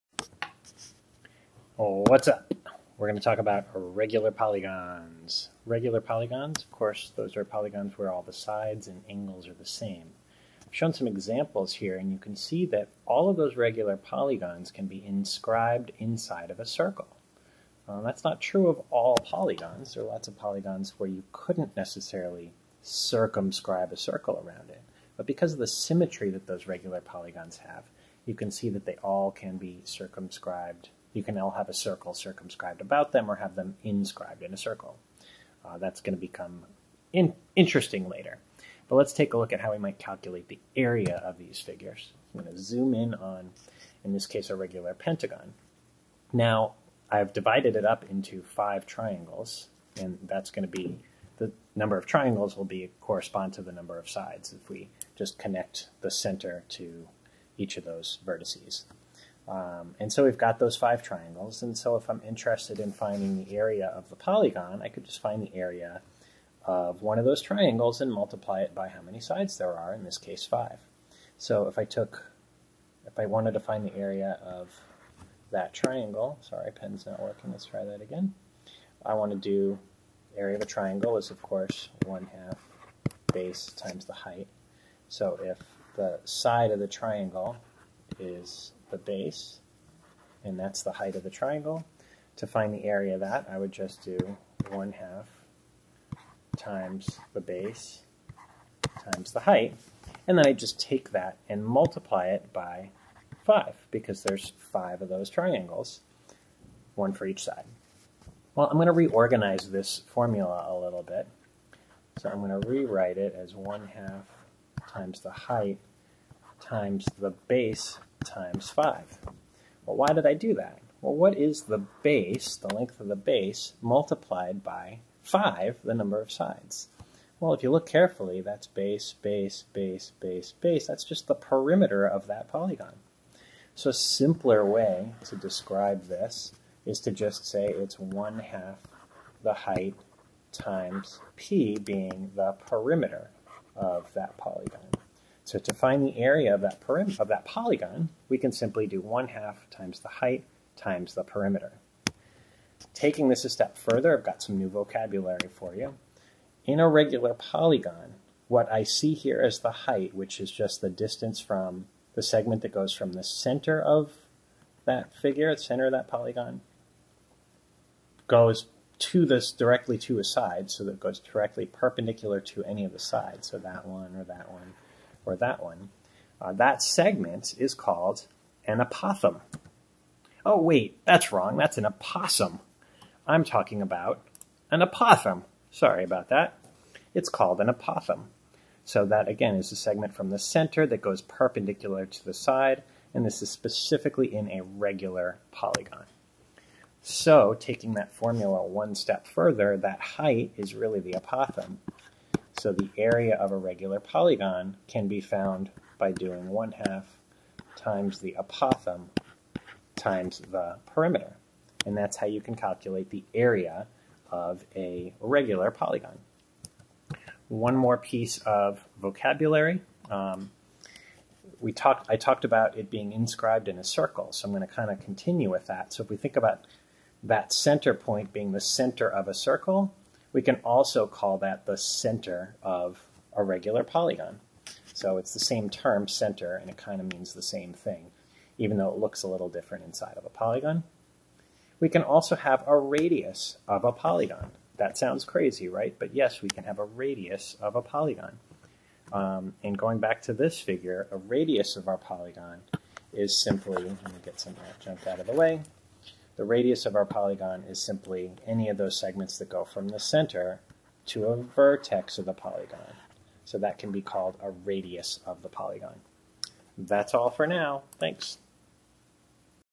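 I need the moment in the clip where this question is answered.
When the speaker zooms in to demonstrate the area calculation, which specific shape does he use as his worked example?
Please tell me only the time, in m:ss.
0:44.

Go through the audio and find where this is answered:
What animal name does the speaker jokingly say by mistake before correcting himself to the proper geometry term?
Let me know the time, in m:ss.
3:01.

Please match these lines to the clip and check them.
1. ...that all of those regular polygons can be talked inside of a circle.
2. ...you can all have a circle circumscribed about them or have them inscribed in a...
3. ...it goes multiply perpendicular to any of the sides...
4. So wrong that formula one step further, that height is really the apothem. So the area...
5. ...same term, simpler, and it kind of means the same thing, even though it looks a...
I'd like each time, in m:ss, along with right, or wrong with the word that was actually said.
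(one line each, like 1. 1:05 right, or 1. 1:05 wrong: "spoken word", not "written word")
1. 0:12 wrong: "inscribed", not "talked"
2. 0:31 right
3. 2:50 wrong: "directly", not "multiply"
4. 3:17 wrong: "taking", not "wrong"
5. 3:55 wrong: "center", not "simpler".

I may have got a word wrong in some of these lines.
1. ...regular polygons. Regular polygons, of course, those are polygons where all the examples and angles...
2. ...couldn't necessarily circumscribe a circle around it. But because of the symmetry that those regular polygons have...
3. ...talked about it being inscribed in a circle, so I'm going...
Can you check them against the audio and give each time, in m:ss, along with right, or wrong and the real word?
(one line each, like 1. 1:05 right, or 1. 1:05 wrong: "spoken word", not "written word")
1. 0:03 wrong: "sides", not "examples"
2. 0:21 right
3. 3:42 right.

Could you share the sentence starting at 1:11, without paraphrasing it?
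So if I took, if I wanted to find the area of that triangle, sorry, pen's not working, let's try that again.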